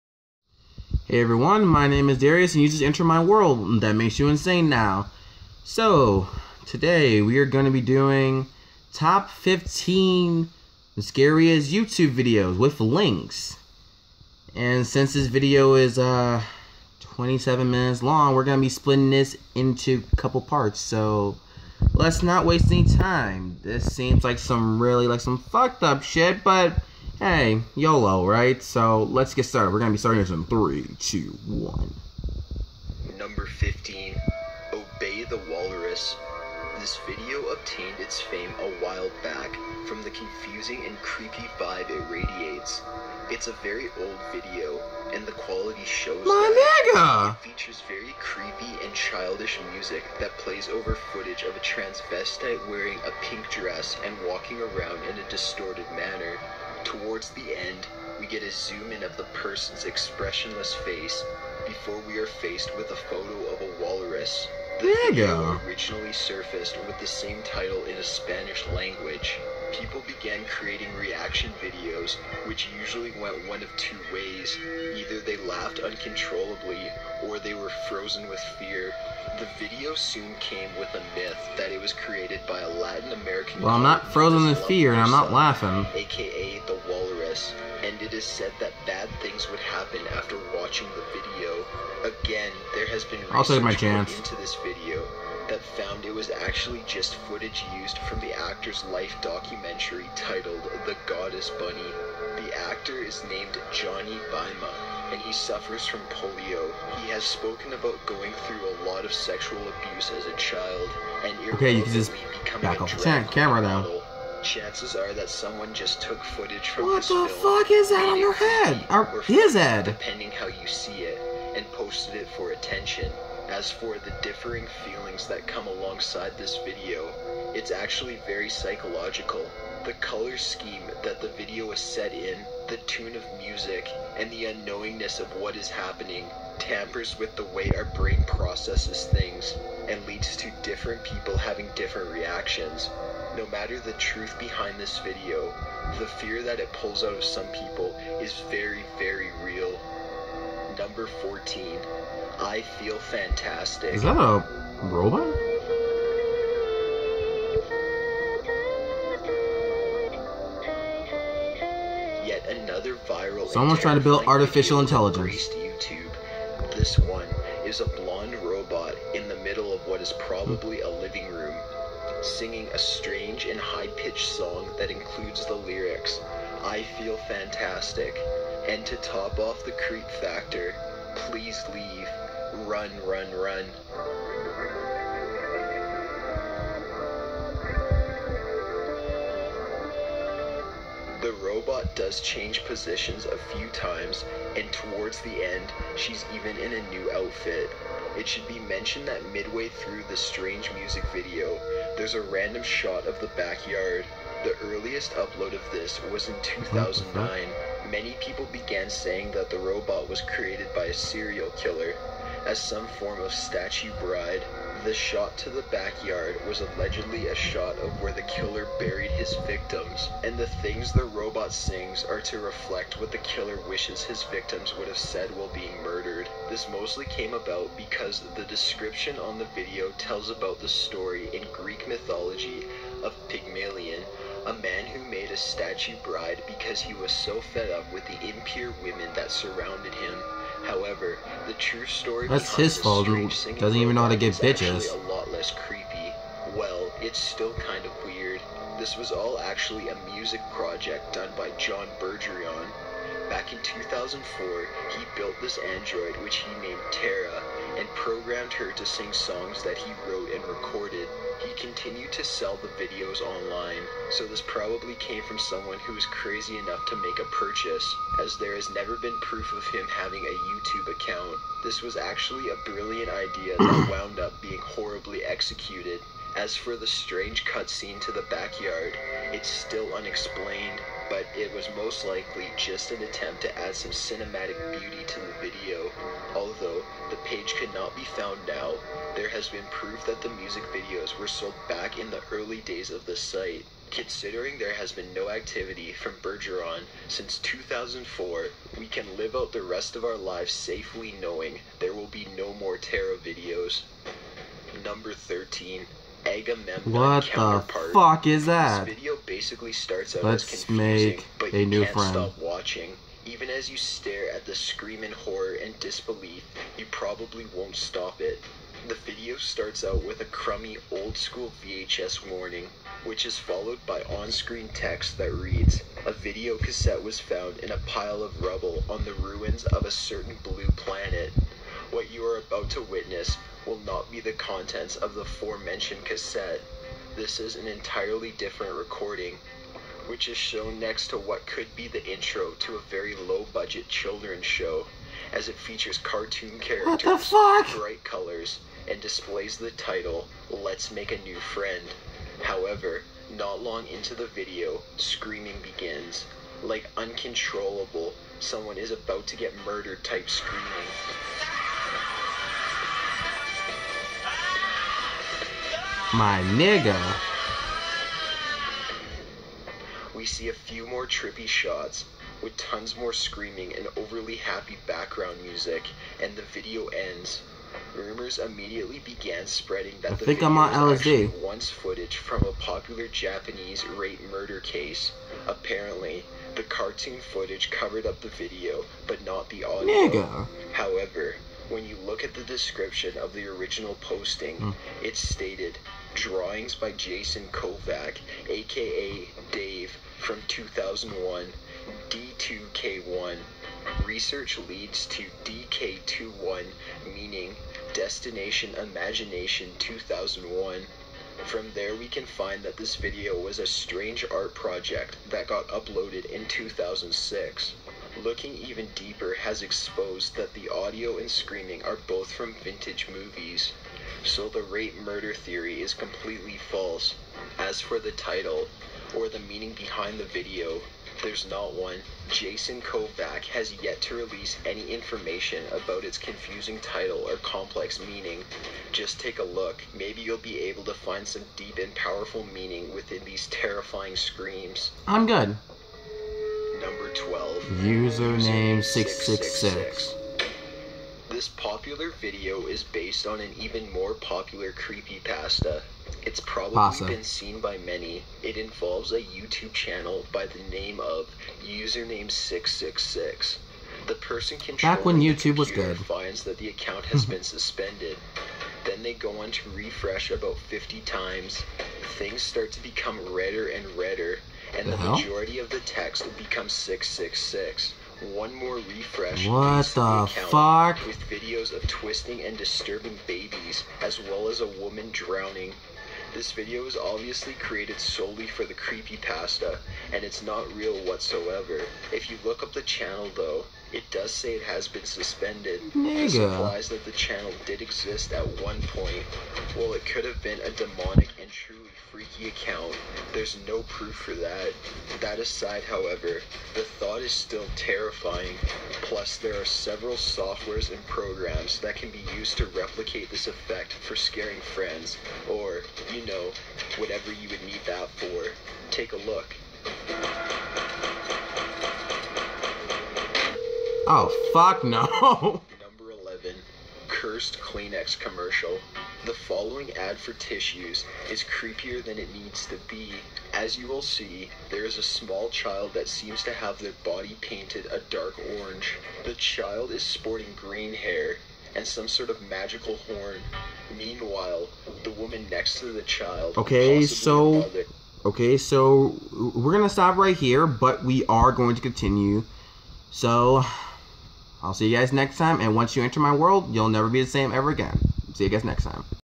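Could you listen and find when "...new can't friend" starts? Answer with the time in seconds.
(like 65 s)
311 s.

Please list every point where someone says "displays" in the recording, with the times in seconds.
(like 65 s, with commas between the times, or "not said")
348 s.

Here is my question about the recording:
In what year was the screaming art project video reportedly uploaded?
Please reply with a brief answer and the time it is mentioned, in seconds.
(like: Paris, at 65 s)
2006, at 416 s.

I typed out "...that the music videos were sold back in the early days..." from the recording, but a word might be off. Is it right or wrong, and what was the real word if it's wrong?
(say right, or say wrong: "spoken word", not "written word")
right.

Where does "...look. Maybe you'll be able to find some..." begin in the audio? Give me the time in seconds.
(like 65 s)
439 s.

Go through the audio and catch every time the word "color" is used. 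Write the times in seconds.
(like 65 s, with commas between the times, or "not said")
129 s, 348 s.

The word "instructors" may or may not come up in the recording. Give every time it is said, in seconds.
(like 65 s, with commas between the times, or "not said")
not said.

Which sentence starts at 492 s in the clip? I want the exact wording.
If you look up the channel though, it does say it has been suspended.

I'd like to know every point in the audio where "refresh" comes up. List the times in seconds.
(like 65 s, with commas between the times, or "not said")
469 s, 478 s.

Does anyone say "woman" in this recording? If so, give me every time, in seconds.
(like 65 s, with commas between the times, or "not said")
484 s, 545 s.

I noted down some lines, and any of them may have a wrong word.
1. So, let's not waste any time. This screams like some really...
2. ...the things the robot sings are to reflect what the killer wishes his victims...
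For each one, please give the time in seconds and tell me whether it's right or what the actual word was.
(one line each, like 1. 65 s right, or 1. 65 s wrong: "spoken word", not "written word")
1. 20 s wrong: "seems", not "screams"
2. 220 s right.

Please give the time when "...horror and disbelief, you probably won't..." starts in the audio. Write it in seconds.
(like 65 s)
315 s.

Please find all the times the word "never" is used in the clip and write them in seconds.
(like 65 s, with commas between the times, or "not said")
268 s, 556 s.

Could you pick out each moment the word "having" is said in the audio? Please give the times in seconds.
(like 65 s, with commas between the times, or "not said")
141 s, 269 s.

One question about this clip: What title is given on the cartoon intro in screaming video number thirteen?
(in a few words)
Let's Make a New Friend.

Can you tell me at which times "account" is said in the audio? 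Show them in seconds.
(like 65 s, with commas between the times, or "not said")
270 s, 466 s, 502 s.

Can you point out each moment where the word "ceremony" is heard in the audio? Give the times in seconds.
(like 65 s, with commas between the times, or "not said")
not said.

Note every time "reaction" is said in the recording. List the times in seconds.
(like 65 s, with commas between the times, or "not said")
70 s, 142 s.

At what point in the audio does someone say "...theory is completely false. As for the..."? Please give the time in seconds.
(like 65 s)
425 s.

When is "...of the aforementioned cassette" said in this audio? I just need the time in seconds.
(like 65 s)
334 s.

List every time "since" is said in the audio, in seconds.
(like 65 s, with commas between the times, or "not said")
14 s, 297 s.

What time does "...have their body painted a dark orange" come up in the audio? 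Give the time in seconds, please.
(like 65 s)
536 s.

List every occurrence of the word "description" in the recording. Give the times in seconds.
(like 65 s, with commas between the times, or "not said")
228 s, 392 s.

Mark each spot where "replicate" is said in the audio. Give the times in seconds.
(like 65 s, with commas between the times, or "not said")
512 s.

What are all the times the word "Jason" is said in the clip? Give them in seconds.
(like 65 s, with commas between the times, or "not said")
396 s, 432 s.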